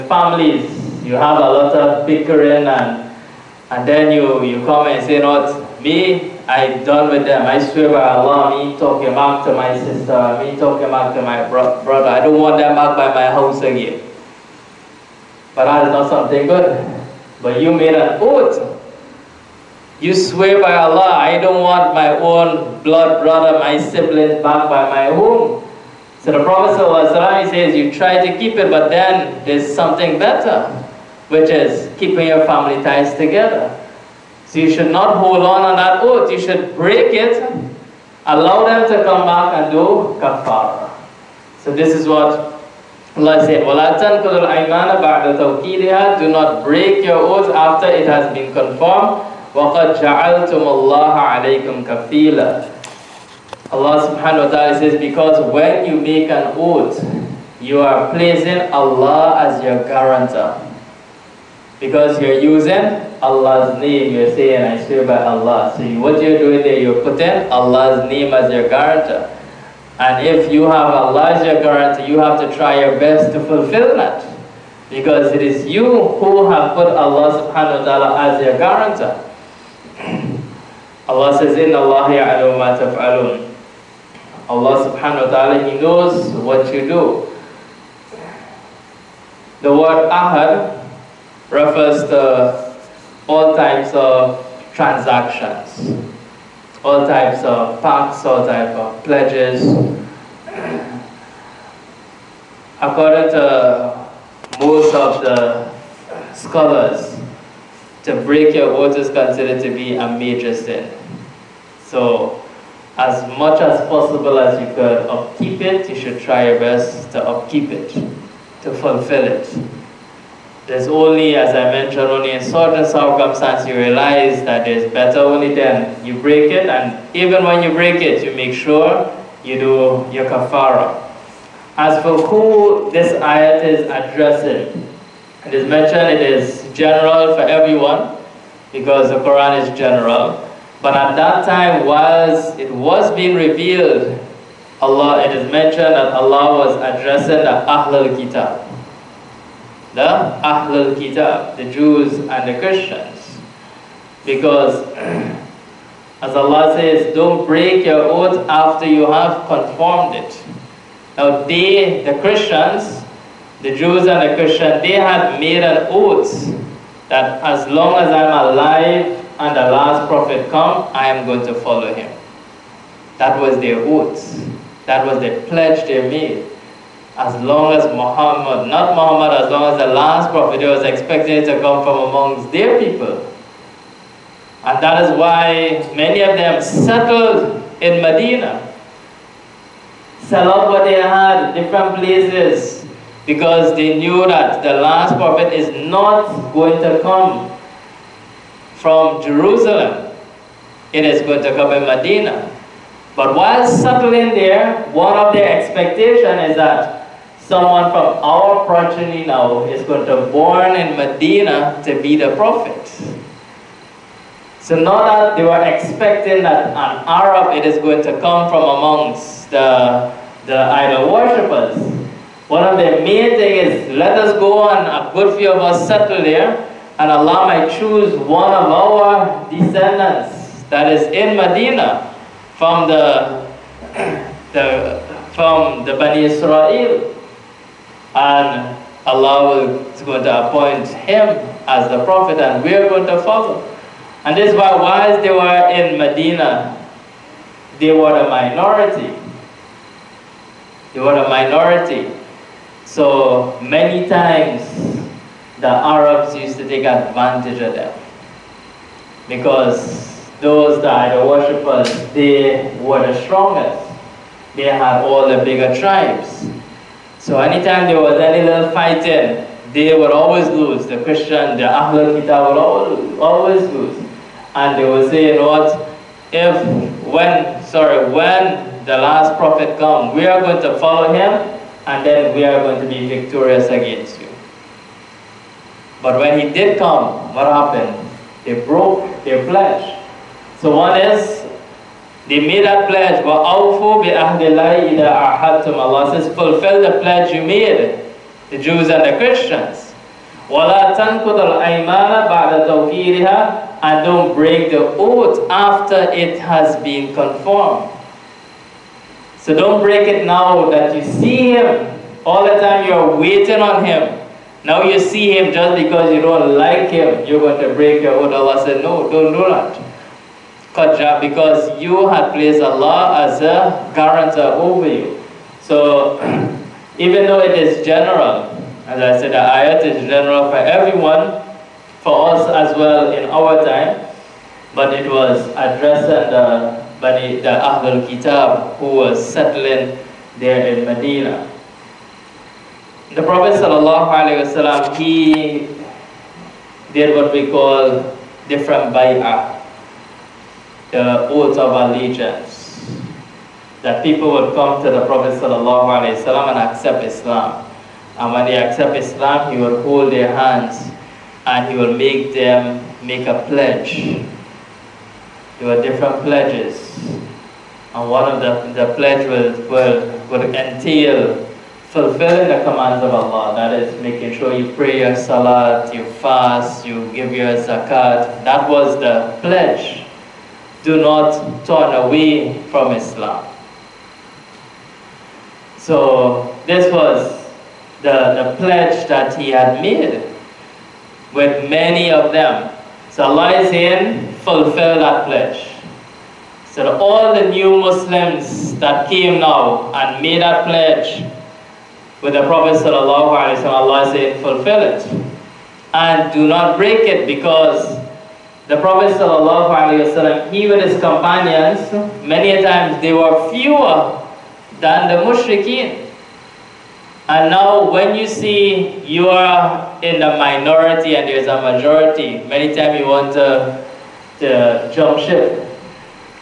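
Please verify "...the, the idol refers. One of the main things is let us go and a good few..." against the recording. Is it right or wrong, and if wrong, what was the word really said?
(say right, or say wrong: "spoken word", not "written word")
wrong: "worshippers", not "refers".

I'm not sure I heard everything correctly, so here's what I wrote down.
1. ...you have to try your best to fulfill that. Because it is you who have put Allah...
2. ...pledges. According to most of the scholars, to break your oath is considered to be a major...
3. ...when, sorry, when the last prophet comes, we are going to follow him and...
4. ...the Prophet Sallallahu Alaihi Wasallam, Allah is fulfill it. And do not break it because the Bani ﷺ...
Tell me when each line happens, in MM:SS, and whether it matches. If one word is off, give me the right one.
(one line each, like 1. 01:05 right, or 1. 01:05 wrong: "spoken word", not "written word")
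1. 01:12 right
2. 01:39 right
3. 04:37 right
4. 06:42 wrong: "Prophet", not "Bani".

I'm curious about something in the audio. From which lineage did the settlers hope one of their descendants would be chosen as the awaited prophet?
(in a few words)
Bani Israel.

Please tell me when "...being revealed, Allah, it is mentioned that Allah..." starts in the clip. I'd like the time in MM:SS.
02:23.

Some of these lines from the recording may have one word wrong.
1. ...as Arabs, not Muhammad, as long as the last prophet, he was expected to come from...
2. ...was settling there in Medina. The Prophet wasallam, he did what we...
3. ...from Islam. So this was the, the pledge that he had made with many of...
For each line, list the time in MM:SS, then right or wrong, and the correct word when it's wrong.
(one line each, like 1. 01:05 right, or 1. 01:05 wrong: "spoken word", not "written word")
1. 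02:57 wrong: "Muhammad", not "Arabs"
2. 05:38 right
3. 06:22 right.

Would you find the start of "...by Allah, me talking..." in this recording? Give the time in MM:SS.
00:07.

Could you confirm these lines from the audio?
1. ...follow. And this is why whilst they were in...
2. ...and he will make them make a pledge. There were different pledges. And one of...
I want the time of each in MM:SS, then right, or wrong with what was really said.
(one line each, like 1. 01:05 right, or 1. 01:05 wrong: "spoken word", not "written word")
1. 04:03 right
2. 06:01 right.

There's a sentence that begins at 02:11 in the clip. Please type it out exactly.
As for who this ayat is addressing, it is mentioned it is general for everyone because the Quran is general.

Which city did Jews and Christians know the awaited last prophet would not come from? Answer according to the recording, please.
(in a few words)
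Jerusalem.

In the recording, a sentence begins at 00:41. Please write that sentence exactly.
So this is what Allah said, وَلَا تَنْقُلُ الْأَيْمَانَ al تَوْكِيدِهَا Do not break your oath after it has been confirmed.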